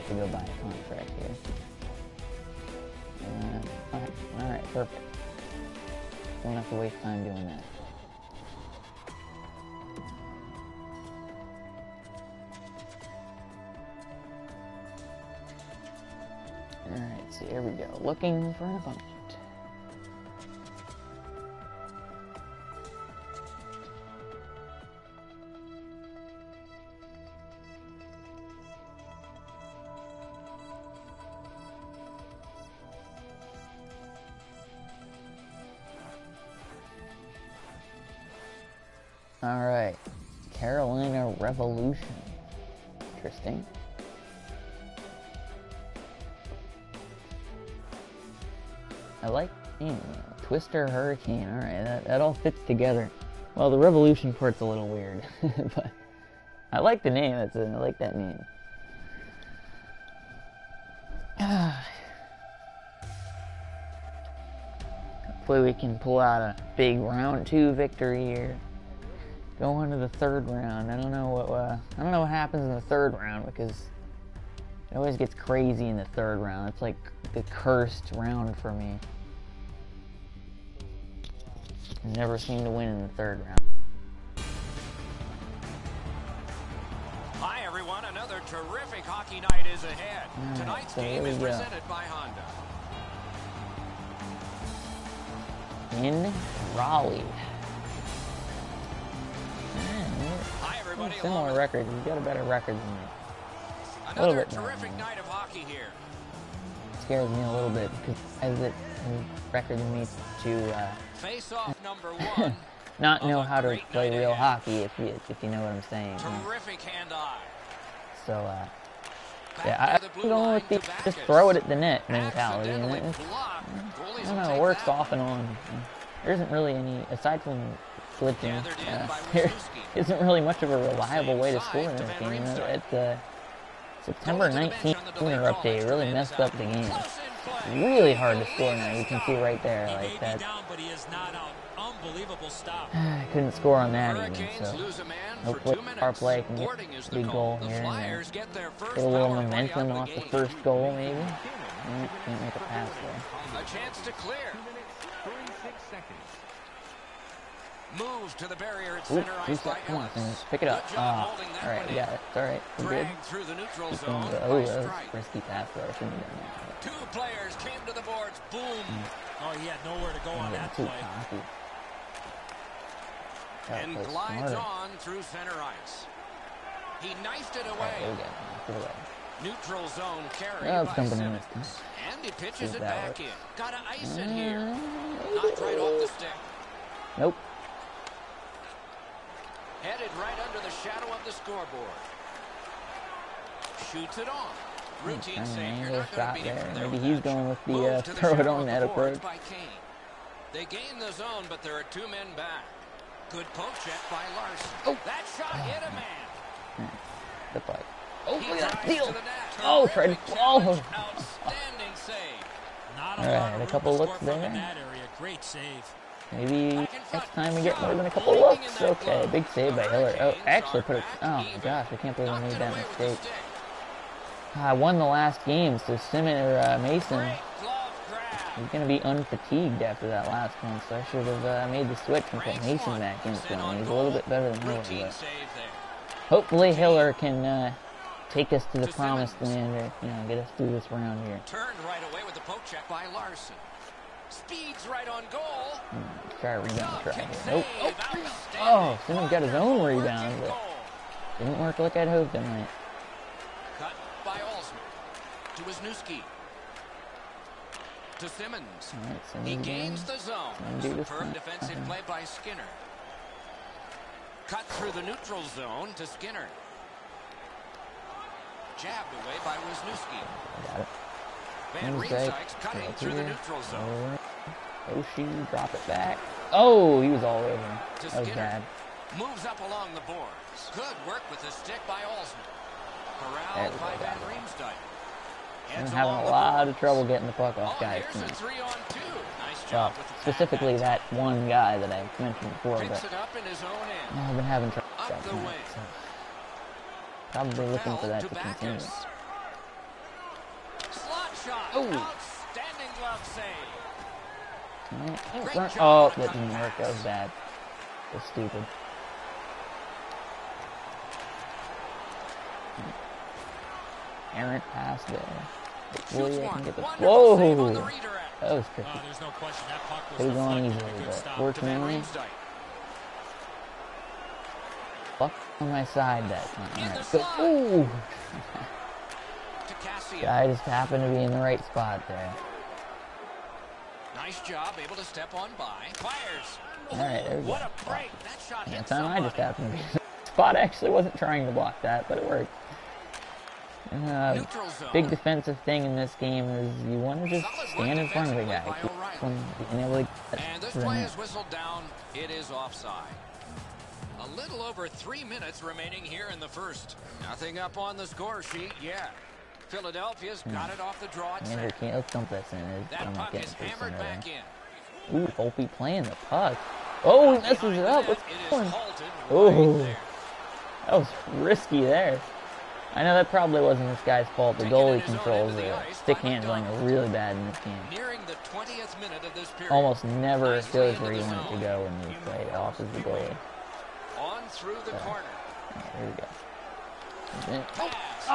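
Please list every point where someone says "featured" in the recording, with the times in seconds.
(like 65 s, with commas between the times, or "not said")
not said.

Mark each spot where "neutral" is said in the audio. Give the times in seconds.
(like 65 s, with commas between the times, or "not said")
163 s, 179 s, 265 s, 273 s.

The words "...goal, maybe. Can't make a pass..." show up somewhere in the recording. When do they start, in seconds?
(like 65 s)
150 s.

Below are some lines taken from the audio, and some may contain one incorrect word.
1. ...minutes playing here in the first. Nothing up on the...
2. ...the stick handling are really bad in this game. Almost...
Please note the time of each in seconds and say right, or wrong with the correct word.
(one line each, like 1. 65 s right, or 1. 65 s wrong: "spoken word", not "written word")
1. 355 s wrong: "remaining", not "playing"
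2. 375 s right.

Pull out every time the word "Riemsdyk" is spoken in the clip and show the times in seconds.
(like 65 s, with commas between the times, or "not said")
271 s, 284 s.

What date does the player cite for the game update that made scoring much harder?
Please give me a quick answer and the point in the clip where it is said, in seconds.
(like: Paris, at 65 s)
September 19, at 134 s.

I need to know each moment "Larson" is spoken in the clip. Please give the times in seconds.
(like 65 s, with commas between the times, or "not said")
204 s, 243 s.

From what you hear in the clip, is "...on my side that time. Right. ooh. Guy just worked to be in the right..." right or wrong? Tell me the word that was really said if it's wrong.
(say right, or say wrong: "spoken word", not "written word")
wrong: "happened", not "worked".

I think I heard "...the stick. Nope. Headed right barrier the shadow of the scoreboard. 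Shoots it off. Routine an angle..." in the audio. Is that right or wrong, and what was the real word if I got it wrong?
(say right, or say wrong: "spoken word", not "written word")
wrong: "under", not "barrier".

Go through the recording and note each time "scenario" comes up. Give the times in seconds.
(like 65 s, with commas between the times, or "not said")
not said.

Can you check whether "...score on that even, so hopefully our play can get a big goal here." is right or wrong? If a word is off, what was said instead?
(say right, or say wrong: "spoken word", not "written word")
right.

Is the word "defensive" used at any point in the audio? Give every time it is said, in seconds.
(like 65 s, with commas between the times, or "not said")
261 s, 345 s.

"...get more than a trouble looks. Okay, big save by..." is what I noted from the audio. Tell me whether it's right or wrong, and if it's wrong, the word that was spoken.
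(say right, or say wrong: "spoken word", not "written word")
wrong: "couple", not "trouble".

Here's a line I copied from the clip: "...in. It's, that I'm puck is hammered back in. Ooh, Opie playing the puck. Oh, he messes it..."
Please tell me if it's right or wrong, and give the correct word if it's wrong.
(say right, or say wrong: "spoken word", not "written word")
right.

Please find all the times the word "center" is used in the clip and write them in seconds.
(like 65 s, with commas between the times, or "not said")
159 s, 175 s.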